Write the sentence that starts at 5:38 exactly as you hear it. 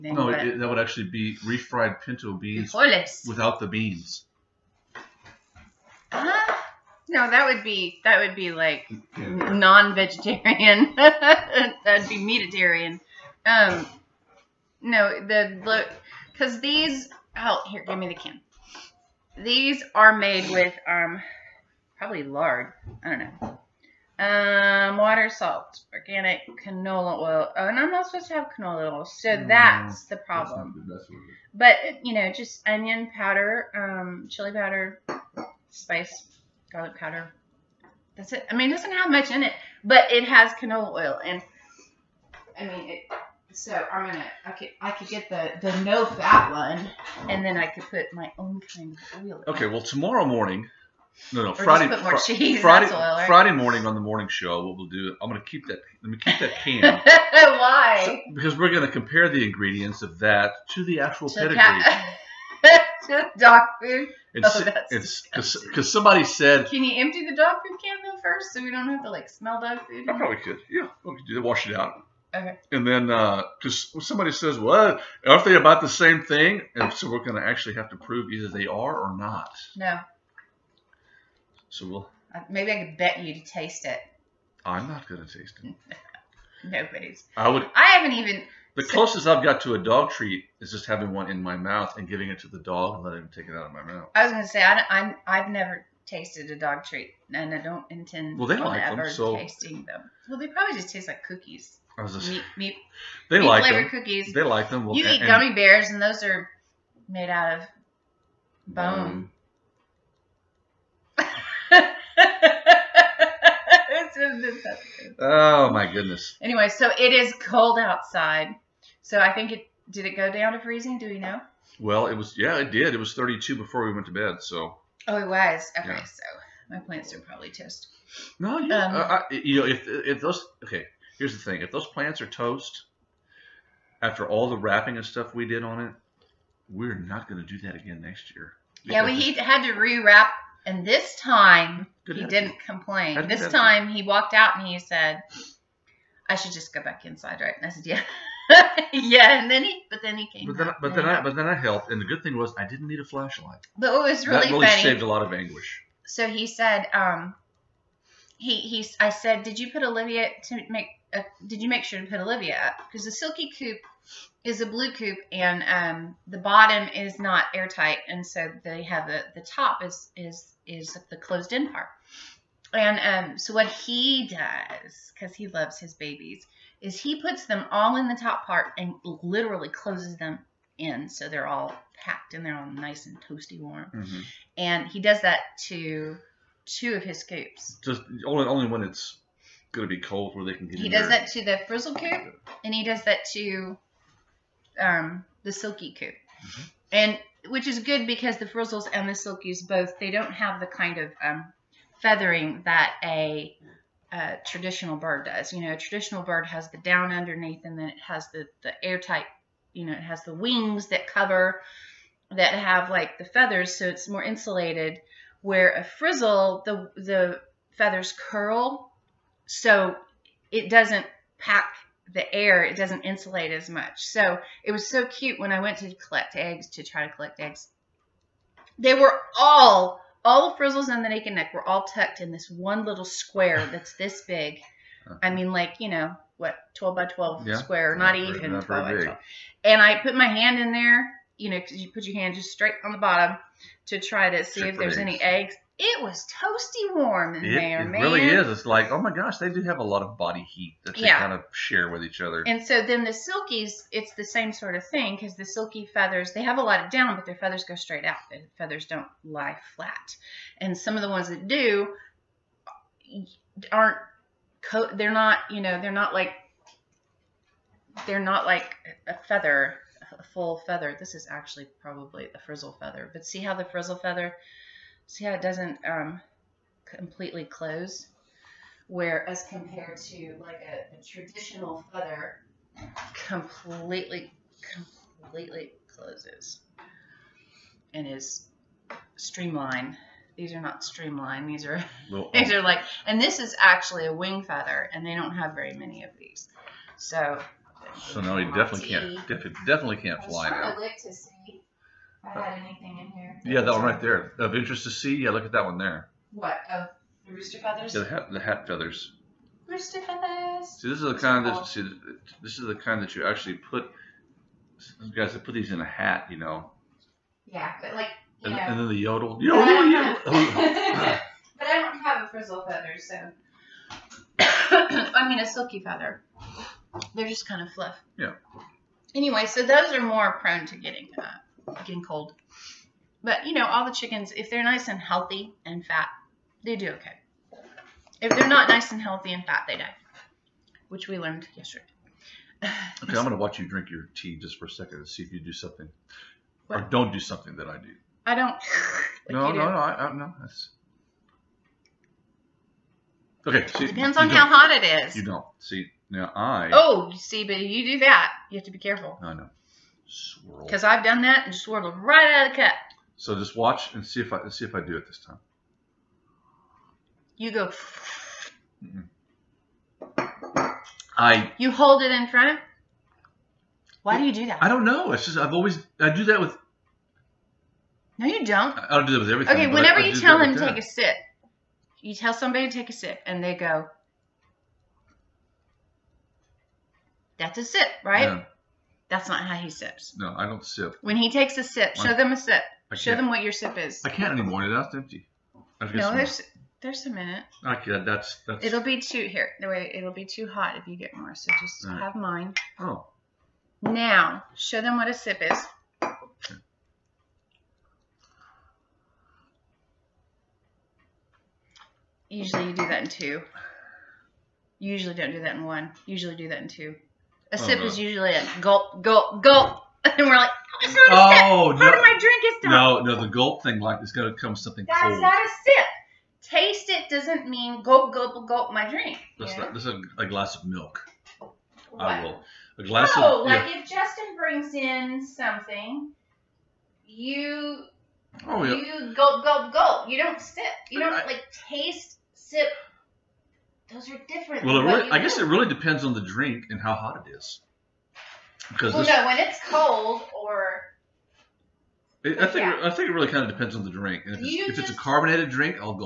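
If they're not nice and healthy and fat, they die, which we learned yesterday.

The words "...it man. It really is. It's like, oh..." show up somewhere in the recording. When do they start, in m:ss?
4:07.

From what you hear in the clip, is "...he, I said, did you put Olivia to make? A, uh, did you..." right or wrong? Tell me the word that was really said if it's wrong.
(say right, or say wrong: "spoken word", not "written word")
right.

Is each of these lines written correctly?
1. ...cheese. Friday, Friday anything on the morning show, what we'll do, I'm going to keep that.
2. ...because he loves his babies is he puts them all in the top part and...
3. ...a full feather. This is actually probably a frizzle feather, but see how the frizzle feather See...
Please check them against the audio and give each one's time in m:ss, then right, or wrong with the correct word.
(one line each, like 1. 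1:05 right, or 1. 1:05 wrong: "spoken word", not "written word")
1. 0:52 wrong: "morning", not "anything"
2. 2:55 right
3. 4:30 right.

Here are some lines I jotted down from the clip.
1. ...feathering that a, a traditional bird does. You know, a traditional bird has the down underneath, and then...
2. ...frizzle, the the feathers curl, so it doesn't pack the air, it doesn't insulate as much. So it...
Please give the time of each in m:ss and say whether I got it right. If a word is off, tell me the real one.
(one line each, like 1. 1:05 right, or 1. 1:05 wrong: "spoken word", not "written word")
1. 3:22 right
2. 3:35 right.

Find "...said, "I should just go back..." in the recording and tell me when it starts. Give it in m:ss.
2:24.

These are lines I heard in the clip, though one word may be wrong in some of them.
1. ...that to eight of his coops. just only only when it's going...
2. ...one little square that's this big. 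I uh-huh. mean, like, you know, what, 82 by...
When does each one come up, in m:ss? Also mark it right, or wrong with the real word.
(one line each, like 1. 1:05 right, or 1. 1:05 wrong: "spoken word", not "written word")
1. 3:05 wrong: "two", not "eight"
2. 3:52 wrong: "12", not "82".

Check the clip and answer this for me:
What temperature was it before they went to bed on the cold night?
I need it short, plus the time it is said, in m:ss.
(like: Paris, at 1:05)
32, at 2:03.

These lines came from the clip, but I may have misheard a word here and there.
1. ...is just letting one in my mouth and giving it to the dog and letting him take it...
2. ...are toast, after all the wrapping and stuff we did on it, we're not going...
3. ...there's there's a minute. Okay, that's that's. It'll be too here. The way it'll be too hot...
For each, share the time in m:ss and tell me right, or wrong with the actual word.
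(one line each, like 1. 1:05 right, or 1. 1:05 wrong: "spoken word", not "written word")
1. 1:30 wrong: "having", not "letting"
2. 2:12 right
3. 6:36 right.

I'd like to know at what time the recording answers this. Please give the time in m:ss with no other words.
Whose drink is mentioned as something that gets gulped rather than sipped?
7:13.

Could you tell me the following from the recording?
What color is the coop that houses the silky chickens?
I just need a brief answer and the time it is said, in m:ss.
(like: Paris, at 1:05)
blue, at 2:44.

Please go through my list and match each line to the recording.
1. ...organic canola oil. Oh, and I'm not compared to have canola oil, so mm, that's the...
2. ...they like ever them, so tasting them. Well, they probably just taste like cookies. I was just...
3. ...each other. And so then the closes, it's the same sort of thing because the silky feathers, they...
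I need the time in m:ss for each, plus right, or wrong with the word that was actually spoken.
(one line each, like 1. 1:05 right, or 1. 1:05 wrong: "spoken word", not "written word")
1. 0:25 wrong: "supposed", not "compared"
2. 1:38 right
3. 4:12 wrong: "silkies", not "closes".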